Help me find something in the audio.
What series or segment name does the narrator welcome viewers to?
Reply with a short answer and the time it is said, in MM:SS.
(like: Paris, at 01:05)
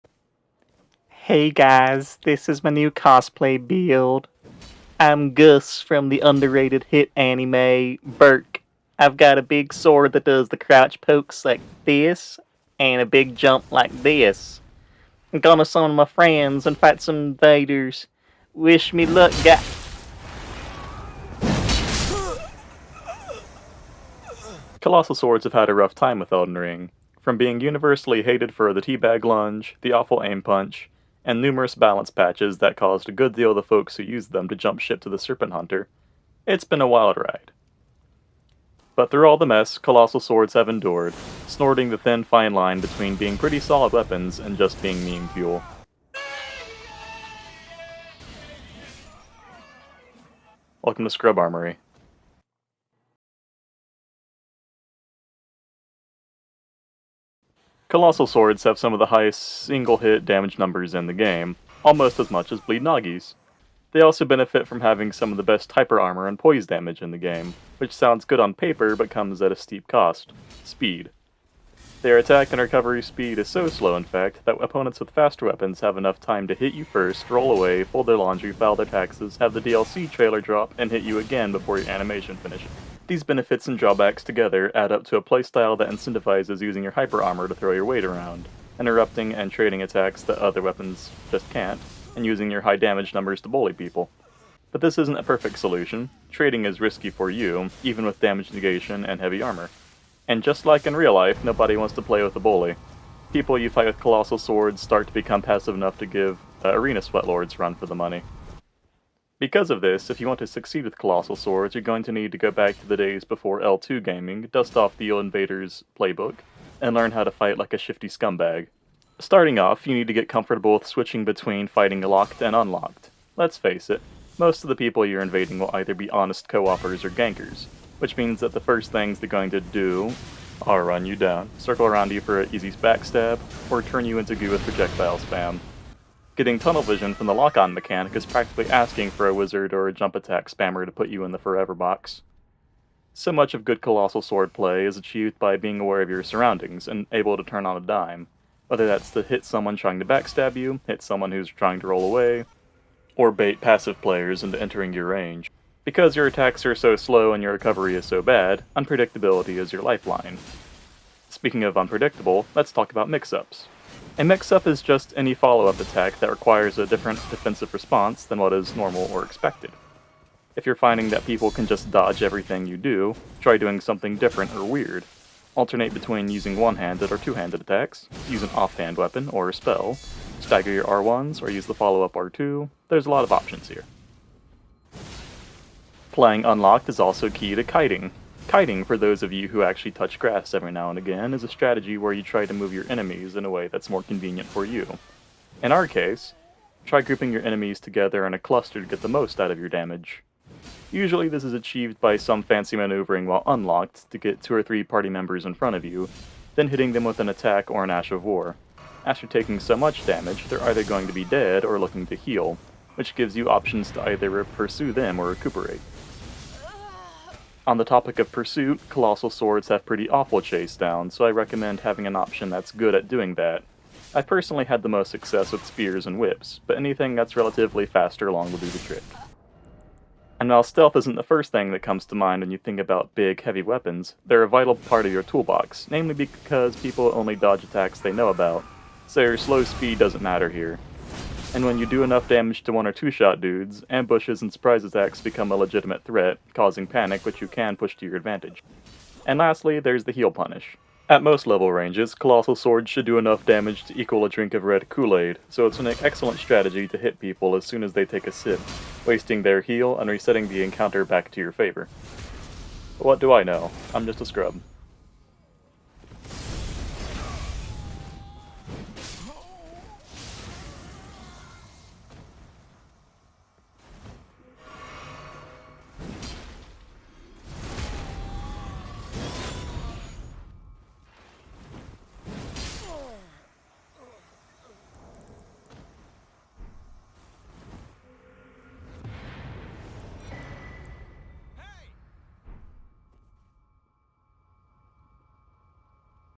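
Scrub Armory, at 00:51.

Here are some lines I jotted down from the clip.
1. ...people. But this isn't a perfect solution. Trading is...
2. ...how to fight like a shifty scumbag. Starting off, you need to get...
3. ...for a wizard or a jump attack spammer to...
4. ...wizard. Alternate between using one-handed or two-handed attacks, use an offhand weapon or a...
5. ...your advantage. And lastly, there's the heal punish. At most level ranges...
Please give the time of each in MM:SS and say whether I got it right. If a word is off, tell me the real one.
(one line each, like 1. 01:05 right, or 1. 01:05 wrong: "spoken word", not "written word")
1. 01:33 right
2. 01:57 right
3. 02:19 right
4. 02:54 wrong: "weird", not "wizard"
5. 04:08 right.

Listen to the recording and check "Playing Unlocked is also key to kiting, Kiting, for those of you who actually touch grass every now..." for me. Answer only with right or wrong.
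right.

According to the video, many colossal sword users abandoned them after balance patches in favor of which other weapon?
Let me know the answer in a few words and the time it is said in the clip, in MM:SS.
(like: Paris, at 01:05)
Serpent Hunter, at 00:35.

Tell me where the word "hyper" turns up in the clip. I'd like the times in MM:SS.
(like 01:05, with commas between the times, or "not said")
01:05, 01:26.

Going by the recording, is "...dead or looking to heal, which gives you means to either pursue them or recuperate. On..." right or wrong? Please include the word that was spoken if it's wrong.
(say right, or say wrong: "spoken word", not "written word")
wrong: "options", not "means".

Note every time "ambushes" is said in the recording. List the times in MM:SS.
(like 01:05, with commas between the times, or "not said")
04:03.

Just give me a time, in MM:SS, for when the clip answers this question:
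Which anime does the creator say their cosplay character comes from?
00:08.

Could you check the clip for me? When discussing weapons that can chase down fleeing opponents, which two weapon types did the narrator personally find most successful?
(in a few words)
Spears and whips.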